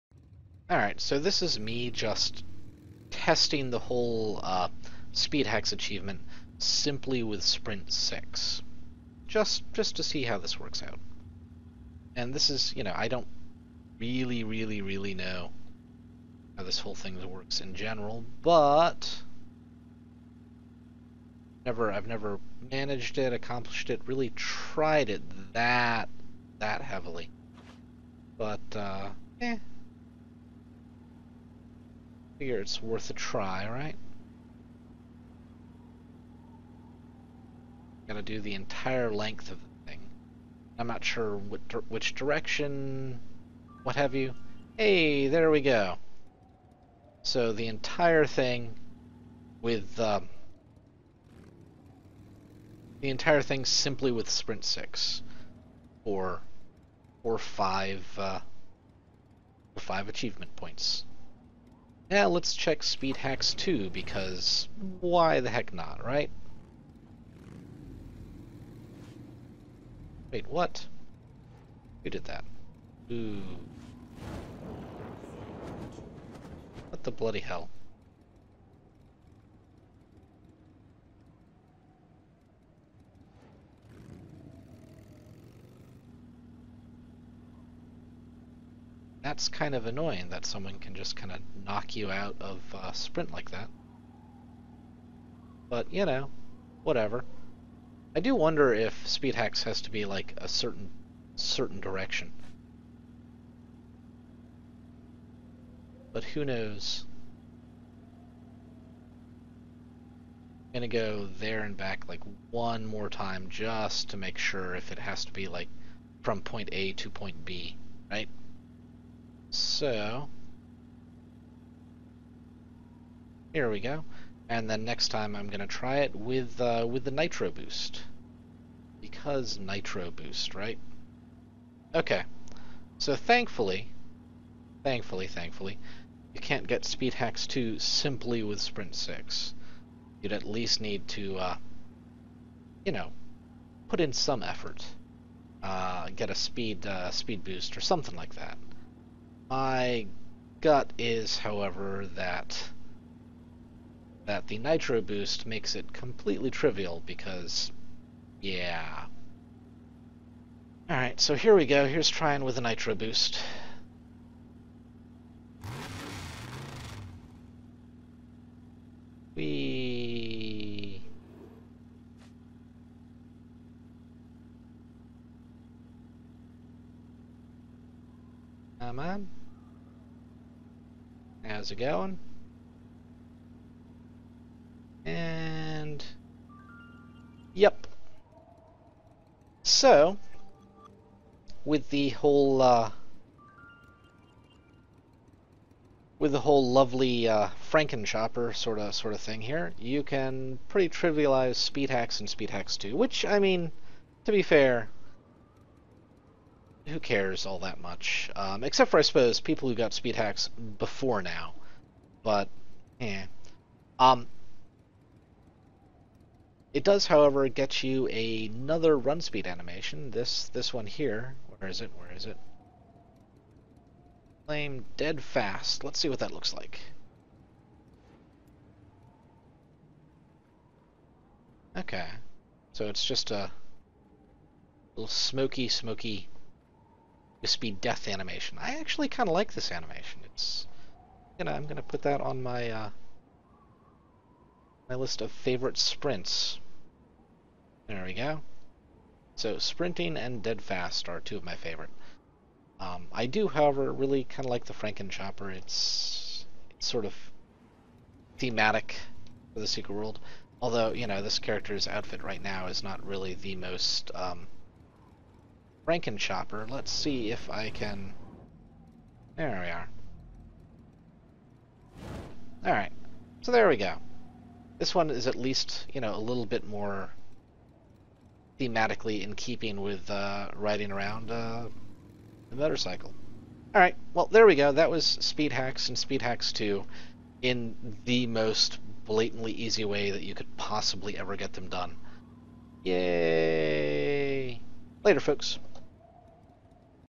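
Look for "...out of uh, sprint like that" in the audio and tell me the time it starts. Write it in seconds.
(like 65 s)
92 s.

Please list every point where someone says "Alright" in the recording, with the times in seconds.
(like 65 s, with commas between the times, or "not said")
0 s, 160 s, 272 s, 283 s.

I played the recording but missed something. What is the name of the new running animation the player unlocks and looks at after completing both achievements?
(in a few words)
Flame dead fast.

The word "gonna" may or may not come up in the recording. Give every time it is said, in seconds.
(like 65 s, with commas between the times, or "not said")
110 s, 241 s.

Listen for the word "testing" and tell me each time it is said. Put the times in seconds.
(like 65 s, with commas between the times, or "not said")
3 s.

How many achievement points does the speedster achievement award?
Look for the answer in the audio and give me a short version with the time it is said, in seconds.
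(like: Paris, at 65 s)
5, at 59 s.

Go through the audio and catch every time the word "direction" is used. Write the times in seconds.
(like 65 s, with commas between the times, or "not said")
42 s, 101 s.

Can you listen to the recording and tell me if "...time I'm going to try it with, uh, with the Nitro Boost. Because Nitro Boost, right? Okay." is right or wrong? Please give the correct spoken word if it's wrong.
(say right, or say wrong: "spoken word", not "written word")
right.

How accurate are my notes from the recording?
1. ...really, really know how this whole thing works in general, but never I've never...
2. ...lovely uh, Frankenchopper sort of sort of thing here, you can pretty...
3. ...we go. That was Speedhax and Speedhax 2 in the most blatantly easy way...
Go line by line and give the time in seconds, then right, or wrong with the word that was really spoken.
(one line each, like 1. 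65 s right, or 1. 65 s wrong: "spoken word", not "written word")
1. 14 s right
2. 196 s right
3. 284 s right.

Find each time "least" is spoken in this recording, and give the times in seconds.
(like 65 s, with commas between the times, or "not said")
140 s, 275 s.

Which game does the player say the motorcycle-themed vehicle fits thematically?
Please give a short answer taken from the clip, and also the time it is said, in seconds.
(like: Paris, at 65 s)
The Secret World, at 259 s.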